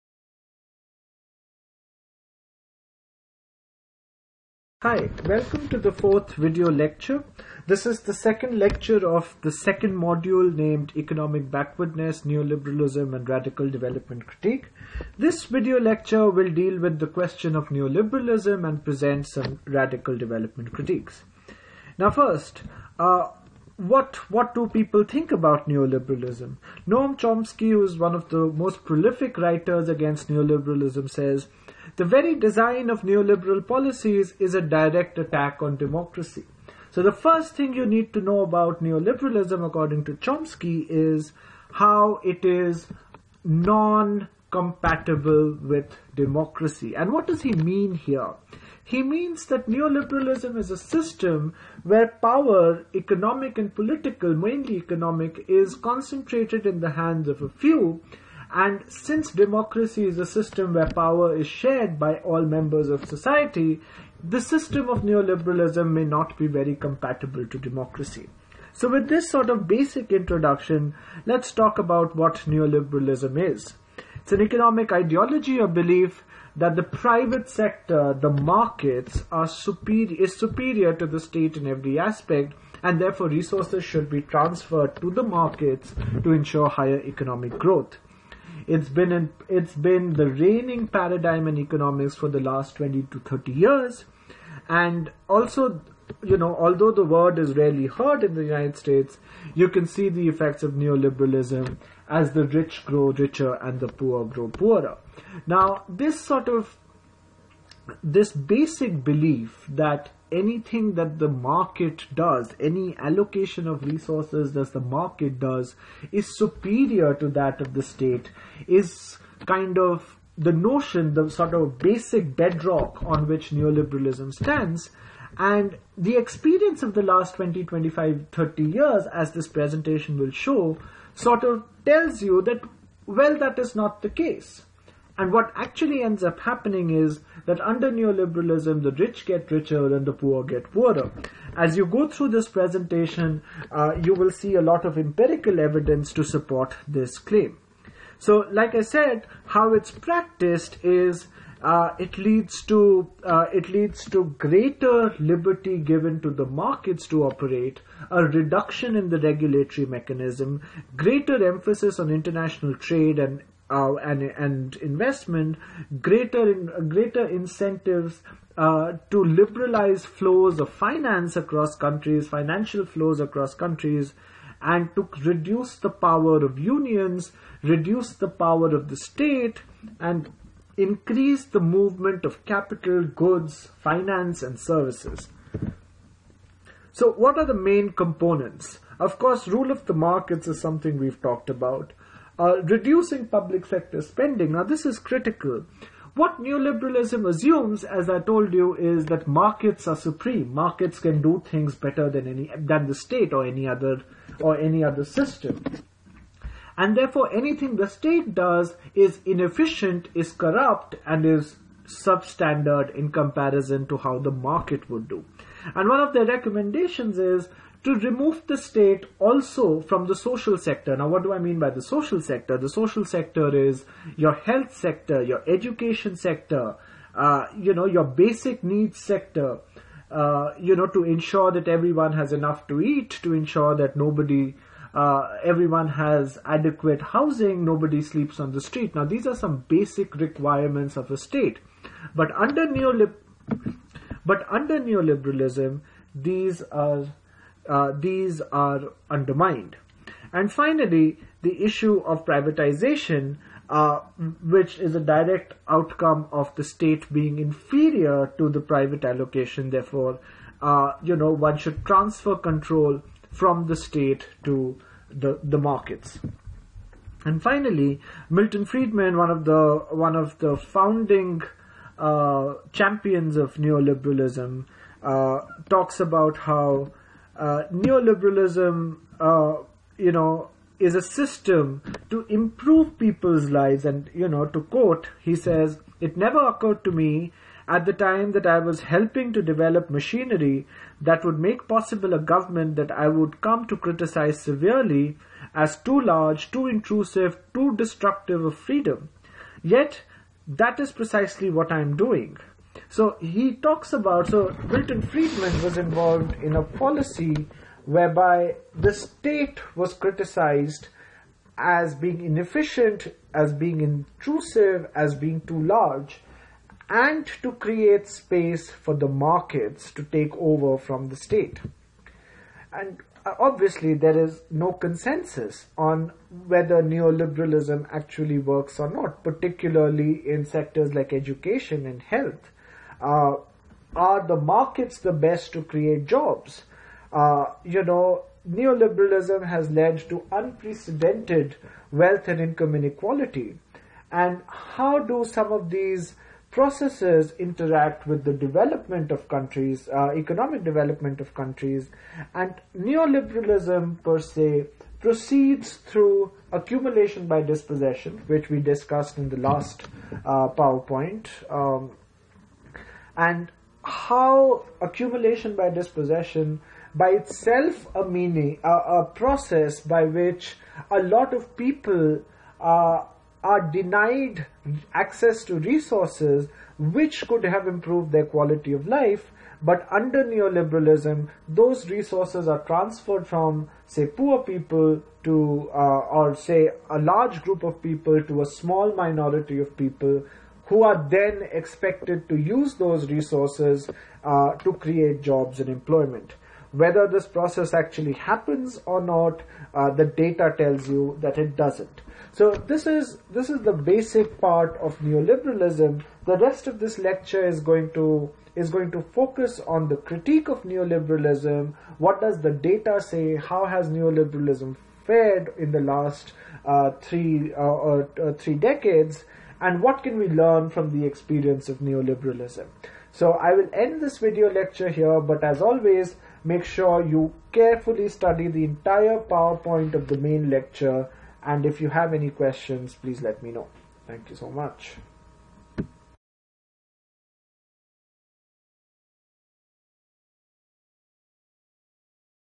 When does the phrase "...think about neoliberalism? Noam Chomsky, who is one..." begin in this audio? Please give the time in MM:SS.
00:25.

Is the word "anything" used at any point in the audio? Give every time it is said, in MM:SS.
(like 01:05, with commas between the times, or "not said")
01:50, 03:27.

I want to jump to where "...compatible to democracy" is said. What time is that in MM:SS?
01:06.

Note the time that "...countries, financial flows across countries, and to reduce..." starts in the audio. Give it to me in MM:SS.
02:51.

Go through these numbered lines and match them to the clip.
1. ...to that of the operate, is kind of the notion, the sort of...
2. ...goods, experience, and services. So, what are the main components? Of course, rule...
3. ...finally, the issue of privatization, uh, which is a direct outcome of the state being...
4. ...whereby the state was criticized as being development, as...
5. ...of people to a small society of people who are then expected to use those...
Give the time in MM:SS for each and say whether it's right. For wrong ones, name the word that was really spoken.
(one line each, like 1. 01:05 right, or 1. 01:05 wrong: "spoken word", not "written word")
1. 01:57 wrong: "state", not "operate"
2. 03:03 wrong: "finance", not "experience"
3. 04:10 right
4. 05:07 wrong: "inefficient", not "development"
5. 06:27 wrong: "minority", not "society".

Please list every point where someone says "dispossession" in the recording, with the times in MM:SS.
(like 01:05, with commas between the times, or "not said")
05:57, 06:05.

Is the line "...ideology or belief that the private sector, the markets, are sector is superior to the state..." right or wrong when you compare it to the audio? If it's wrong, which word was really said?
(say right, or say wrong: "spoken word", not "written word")
wrong: "superior", not "sector".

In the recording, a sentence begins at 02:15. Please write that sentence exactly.
And what actually ends up happening is that under neoliberalism, the rich get richer and the poor get poorer.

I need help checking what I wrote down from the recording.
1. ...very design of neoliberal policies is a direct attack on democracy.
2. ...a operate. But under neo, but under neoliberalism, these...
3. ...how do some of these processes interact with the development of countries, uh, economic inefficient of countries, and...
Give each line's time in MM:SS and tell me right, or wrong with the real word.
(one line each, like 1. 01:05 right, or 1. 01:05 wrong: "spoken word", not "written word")
1. 00:32 right
2. 04:01 wrong: "state", not "operate"
3. 05:44 wrong: "development", not "inefficient".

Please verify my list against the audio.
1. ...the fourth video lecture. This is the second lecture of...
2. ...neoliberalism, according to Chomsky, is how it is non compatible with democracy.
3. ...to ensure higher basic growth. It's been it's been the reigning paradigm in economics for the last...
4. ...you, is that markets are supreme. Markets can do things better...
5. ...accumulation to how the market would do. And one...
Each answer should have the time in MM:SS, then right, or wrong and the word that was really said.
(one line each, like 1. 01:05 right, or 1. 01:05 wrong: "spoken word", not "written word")
1. 00:05 right
2. 00:38 right
3. 01:26 wrong: "economic", not "basic"
4. 03:18 right
5. 03:33 wrong: "comparison", not "accumulation".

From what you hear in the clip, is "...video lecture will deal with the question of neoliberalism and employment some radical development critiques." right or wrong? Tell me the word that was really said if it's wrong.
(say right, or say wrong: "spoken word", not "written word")
wrong: "present", not "employment".